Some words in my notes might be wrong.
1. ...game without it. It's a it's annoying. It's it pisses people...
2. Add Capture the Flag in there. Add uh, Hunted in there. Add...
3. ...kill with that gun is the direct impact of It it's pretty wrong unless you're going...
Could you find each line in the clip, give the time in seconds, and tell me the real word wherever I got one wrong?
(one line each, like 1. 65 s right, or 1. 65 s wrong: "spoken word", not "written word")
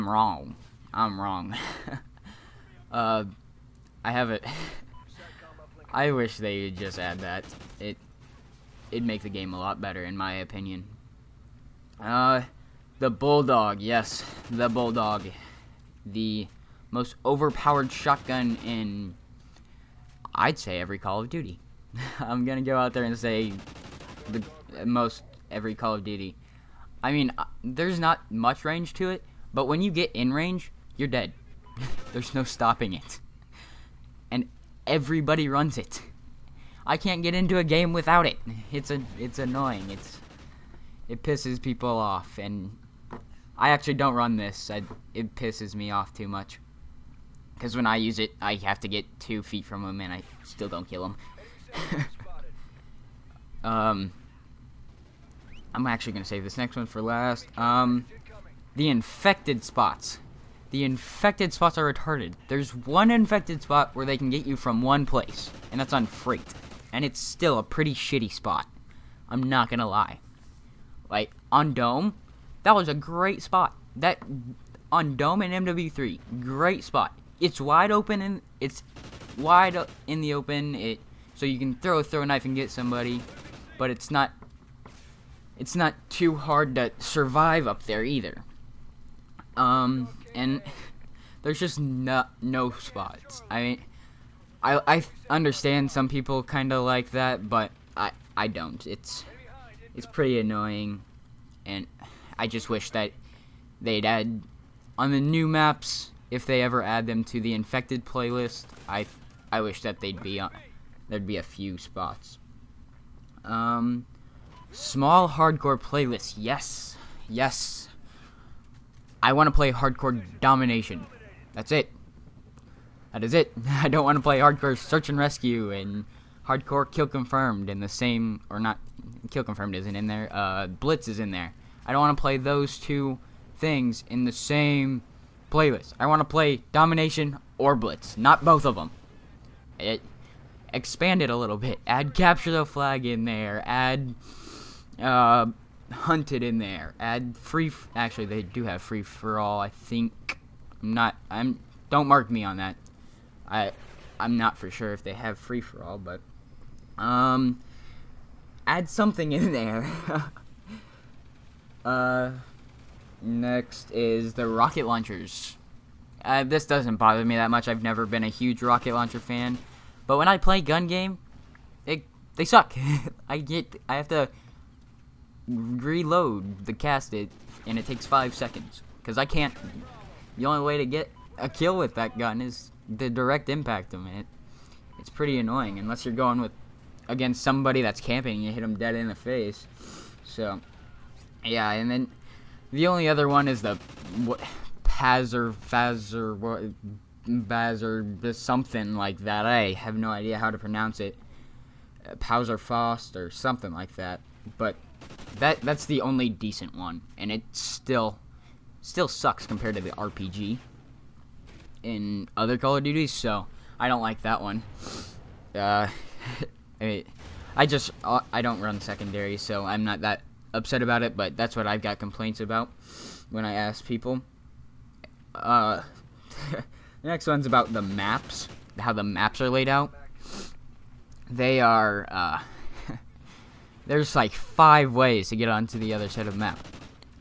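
1. 37 s right
2. 141 s right
3. 181 s wrong: "annoying", not "wrong".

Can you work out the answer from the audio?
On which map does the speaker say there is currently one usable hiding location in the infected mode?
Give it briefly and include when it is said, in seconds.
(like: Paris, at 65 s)
Freight, at 66 s.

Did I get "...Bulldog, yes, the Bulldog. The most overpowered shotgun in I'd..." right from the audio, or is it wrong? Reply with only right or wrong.
right.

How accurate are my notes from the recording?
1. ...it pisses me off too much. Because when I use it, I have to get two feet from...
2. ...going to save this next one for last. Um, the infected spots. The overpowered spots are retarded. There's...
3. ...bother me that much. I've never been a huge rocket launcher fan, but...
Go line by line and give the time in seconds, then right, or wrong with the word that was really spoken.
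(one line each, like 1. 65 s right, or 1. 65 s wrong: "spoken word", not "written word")
1. 45 s right
2. 56 s wrong: "infected", not "overpowered"
3. 166 s right.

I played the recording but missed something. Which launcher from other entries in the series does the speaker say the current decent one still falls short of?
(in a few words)
RPG.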